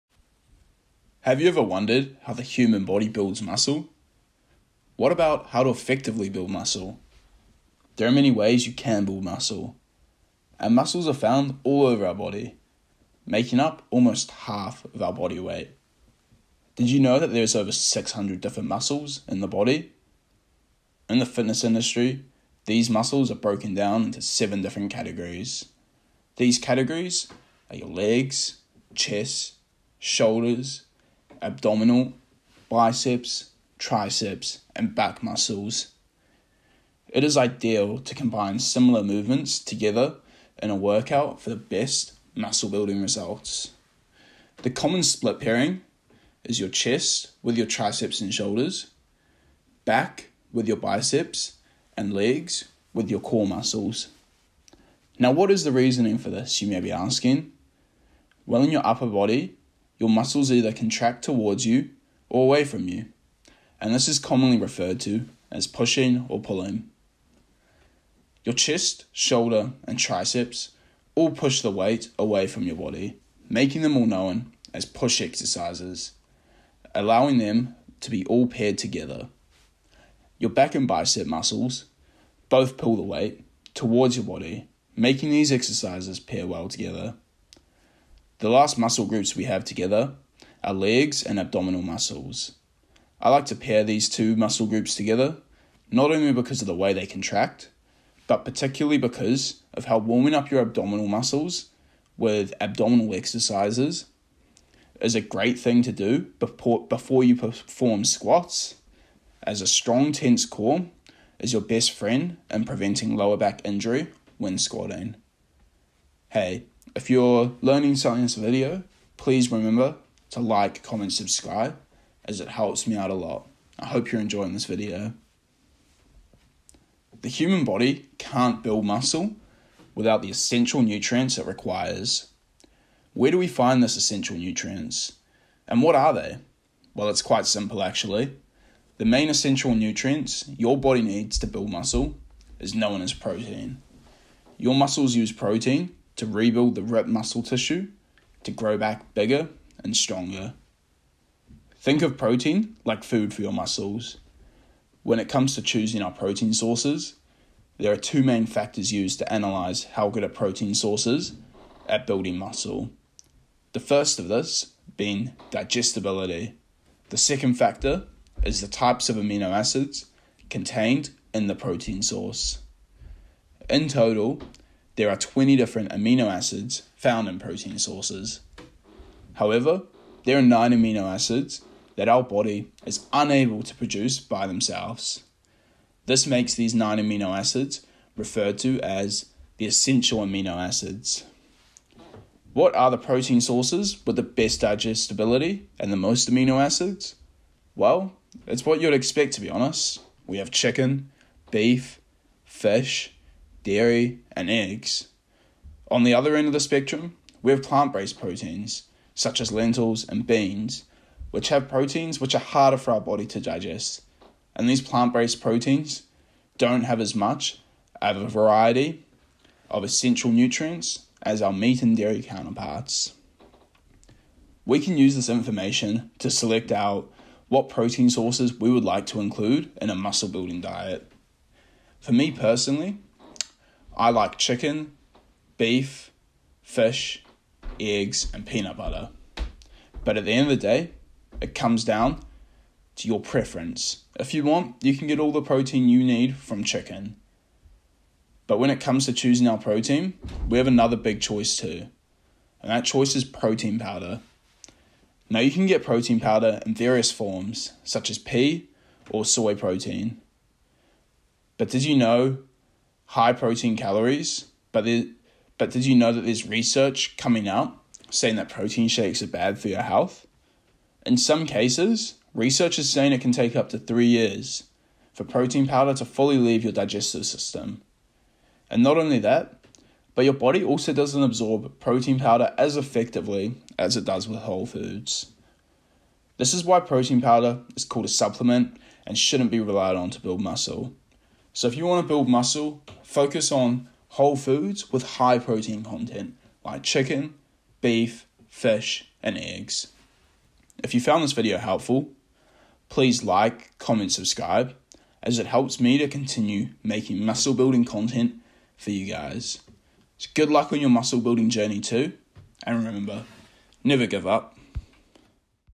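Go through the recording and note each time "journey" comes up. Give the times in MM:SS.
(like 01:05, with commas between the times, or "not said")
05:11.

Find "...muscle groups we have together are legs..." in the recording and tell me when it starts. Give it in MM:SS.
01:28.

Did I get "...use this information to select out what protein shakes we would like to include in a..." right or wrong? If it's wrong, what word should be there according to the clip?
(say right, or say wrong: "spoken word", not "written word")
wrong: "sources", not "shakes".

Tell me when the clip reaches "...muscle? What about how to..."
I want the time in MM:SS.
00:03.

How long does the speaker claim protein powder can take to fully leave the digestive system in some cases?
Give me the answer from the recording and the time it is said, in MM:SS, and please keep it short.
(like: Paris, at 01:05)
3 years, at 04:33.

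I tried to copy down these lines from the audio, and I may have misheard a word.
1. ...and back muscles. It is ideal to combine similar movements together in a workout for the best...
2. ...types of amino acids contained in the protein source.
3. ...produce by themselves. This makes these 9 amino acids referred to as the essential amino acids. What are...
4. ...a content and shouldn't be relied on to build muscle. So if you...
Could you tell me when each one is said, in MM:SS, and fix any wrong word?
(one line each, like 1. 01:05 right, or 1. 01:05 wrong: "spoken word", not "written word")
1. 00:34 right
2. 02:48 right
3. 03:03 right
4. 04:48 wrong: "supplement", not "content".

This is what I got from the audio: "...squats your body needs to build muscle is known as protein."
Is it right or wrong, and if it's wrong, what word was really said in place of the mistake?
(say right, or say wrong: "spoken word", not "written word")
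wrong: "nutrients", not "squats".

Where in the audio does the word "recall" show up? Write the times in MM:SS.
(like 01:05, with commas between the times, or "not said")
not said.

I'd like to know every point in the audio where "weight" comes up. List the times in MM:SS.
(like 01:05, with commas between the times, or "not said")
00:15, 01:11, 01:23.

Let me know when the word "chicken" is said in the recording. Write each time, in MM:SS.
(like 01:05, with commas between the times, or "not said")
03:20, 03:54, 04:06, 04:56.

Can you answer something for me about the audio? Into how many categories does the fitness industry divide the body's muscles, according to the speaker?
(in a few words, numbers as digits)
7.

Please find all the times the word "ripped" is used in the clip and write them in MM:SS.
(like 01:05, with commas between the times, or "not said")
02:26.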